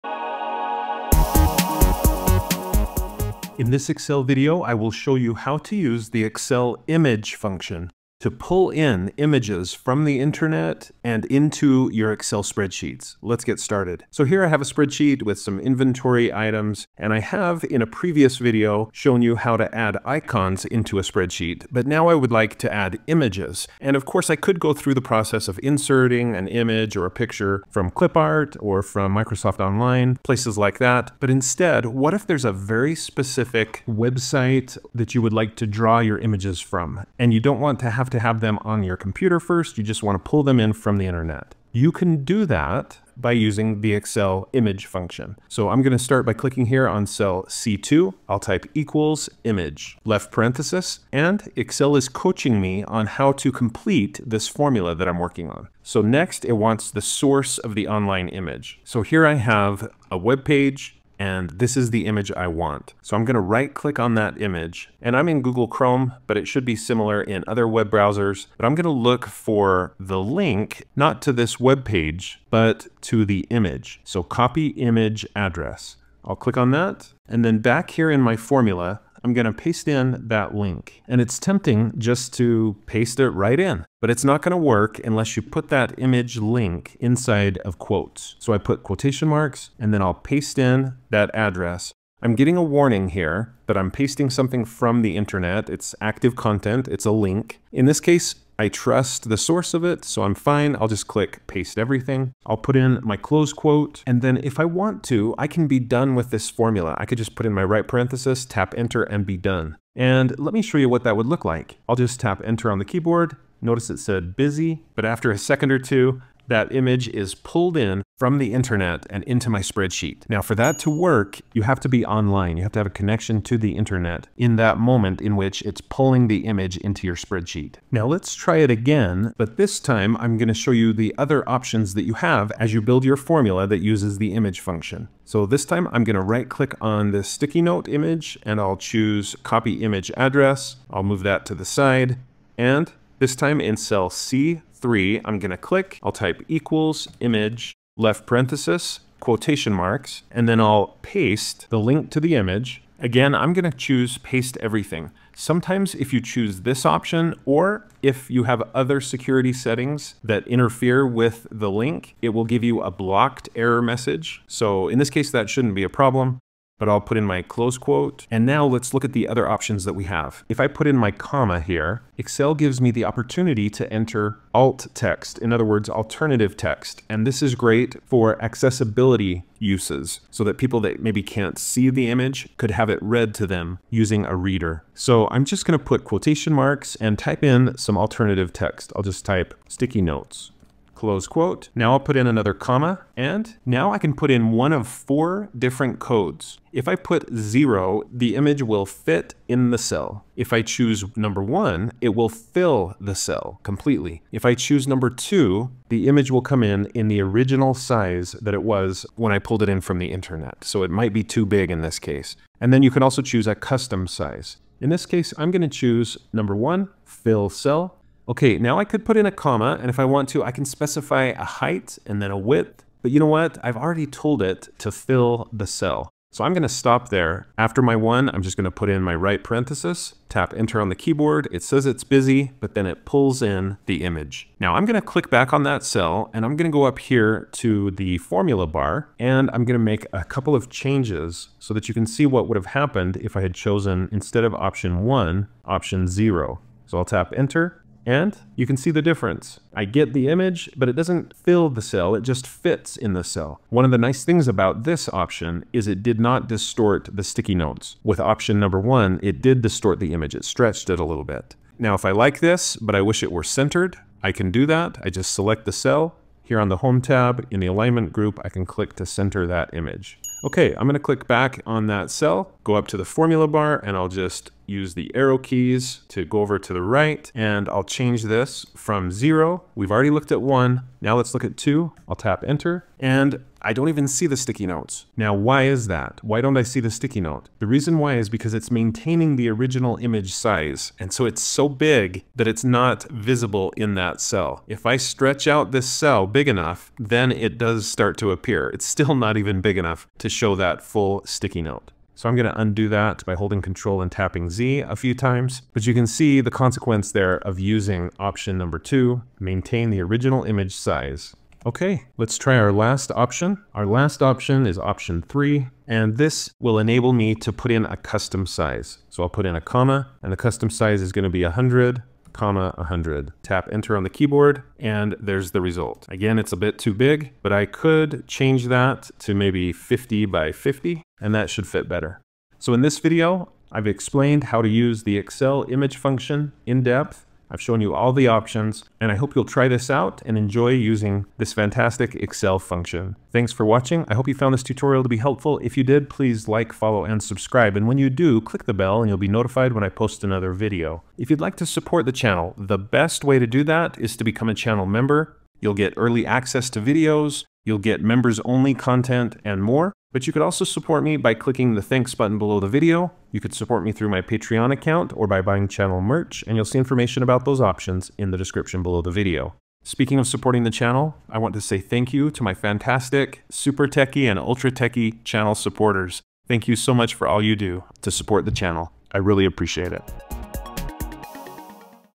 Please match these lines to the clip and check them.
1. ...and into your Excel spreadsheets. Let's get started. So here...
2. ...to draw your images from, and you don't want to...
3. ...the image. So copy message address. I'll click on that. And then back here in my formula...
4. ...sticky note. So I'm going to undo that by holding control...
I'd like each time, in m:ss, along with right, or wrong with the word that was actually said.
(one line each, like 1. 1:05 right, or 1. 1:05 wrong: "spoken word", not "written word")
1. 0:11 right
2. 0:35 right
3. 1:13 wrong: "image", not "message"
4. 5:01 right.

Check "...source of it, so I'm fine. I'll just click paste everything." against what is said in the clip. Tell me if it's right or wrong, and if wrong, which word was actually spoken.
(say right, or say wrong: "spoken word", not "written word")
right.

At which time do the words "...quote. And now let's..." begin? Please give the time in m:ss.
2:47.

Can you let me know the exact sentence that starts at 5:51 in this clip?
If you'd like to support the channel, the best way to do that is to become a channel member.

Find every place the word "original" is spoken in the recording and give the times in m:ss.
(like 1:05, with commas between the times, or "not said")
3:27, 4:49, 5:10.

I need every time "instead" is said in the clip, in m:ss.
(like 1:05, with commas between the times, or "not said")
0:31, 4:04.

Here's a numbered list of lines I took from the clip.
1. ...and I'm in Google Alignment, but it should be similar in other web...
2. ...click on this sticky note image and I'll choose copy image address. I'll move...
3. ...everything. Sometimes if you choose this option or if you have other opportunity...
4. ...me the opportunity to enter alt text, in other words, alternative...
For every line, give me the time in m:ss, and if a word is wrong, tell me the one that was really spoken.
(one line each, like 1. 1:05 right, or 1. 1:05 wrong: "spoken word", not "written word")
1. 1:05 wrong: "Chrome", not "Alignment"
2. 2:16 right
3. 2:34 wrong: "security", not "opportunity"
4. 2:52 right.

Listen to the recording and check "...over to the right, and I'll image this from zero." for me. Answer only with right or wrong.
wrong.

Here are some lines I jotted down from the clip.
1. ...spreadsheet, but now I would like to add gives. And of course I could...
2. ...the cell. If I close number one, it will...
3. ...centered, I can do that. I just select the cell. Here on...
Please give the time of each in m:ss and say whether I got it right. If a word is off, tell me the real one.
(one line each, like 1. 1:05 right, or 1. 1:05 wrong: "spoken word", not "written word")
1. 0:21 wrong: "images", not "gives"
2. 3:19 wrong: "choose", not "close"
3. 4:23 right.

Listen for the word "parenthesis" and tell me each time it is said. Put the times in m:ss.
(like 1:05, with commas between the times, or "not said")
0:50, 1:47, 2:28, 3:49.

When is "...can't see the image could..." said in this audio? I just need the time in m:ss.
3:01.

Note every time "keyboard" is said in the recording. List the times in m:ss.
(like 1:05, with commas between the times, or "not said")
1:52, 3:50, 5:24.